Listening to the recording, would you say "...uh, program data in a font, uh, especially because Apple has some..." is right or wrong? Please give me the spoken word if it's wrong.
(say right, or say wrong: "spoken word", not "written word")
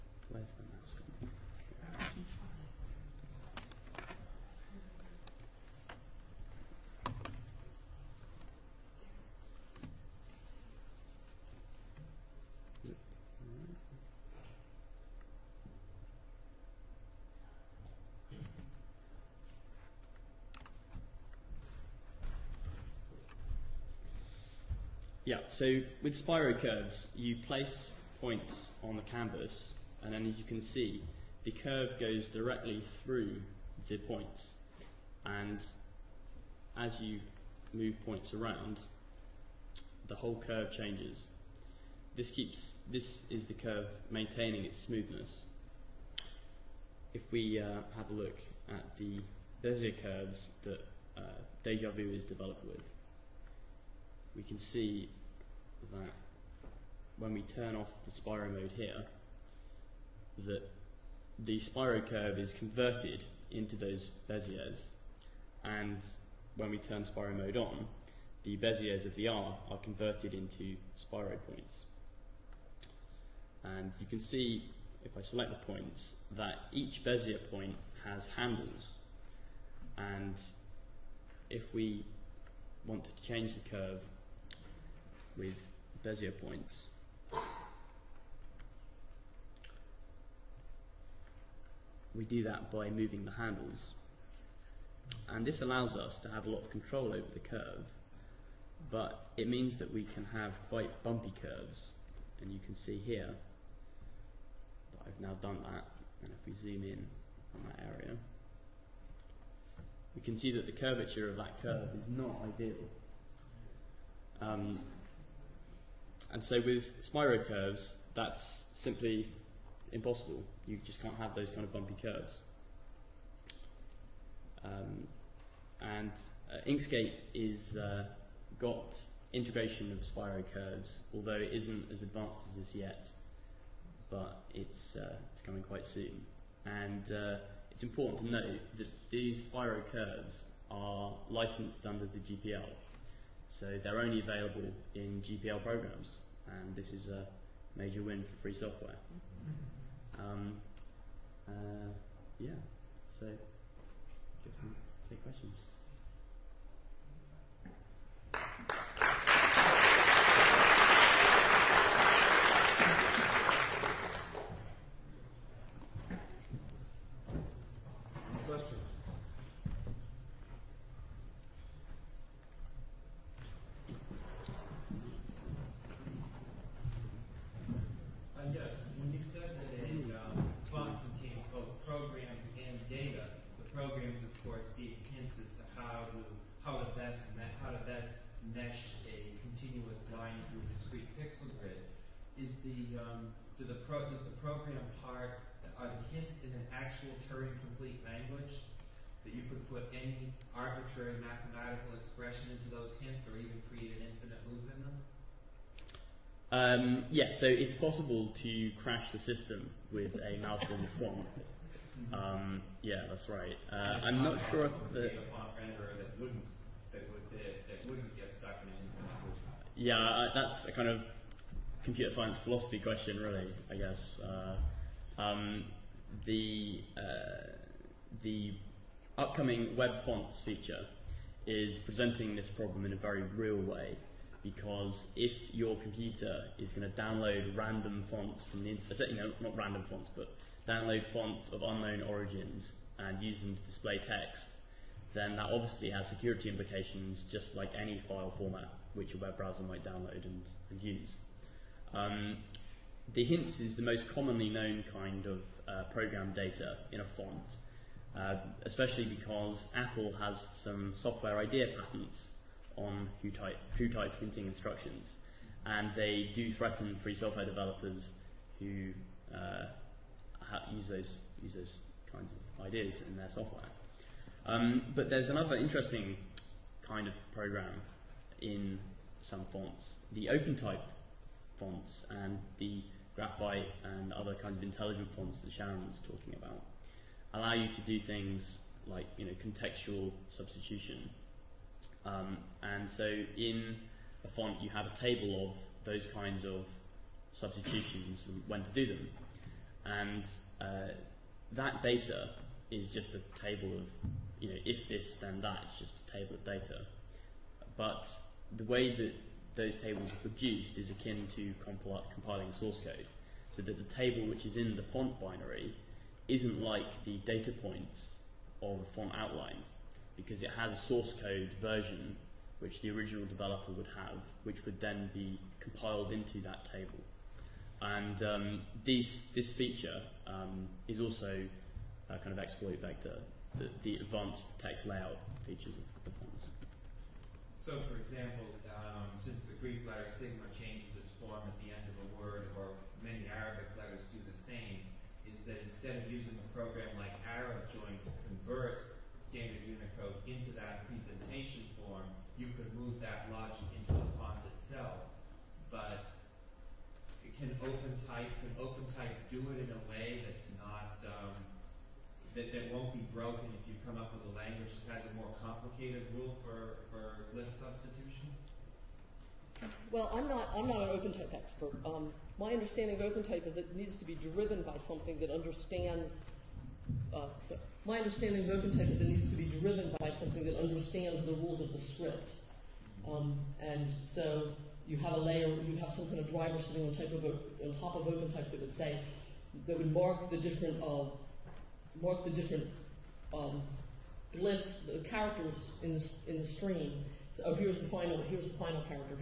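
right.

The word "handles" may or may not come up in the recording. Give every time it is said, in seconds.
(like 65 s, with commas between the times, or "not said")
78 s, 93 s.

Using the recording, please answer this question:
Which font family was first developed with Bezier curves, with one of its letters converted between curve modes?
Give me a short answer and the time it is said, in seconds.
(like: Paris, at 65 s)
DejaVu, at 51 s.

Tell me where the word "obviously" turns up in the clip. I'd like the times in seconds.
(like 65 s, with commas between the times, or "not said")
245 s.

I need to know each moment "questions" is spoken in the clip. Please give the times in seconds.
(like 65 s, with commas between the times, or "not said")
155 s, 222 s.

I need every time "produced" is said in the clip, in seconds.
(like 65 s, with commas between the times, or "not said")
310 s.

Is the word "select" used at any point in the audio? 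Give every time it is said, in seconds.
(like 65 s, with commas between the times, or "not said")
75 s.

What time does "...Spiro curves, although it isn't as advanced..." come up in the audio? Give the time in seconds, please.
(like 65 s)
130 s.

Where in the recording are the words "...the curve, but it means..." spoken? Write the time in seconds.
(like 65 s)
97 s.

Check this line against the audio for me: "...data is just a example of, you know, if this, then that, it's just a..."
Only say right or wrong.
wrong.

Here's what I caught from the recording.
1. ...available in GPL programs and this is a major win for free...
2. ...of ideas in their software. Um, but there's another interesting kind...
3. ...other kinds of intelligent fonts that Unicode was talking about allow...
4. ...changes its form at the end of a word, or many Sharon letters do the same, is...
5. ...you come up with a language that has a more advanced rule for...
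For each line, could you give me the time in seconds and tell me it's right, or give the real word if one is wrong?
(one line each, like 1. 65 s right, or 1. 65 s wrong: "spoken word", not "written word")
1. 144 s right
2. 272 s right
3. 284 s wrong: "Sharon", not "Unicode"
4. 340 s wrong: "Arabic", not "Sharon"
5. 363 s wrong: "complicated", not "advanced".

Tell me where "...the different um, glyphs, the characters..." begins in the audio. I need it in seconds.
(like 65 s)
392 s.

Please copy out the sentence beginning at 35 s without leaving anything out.
And as you move points around, the whole curve changes.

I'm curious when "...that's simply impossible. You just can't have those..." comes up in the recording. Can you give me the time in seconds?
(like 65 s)
118 s.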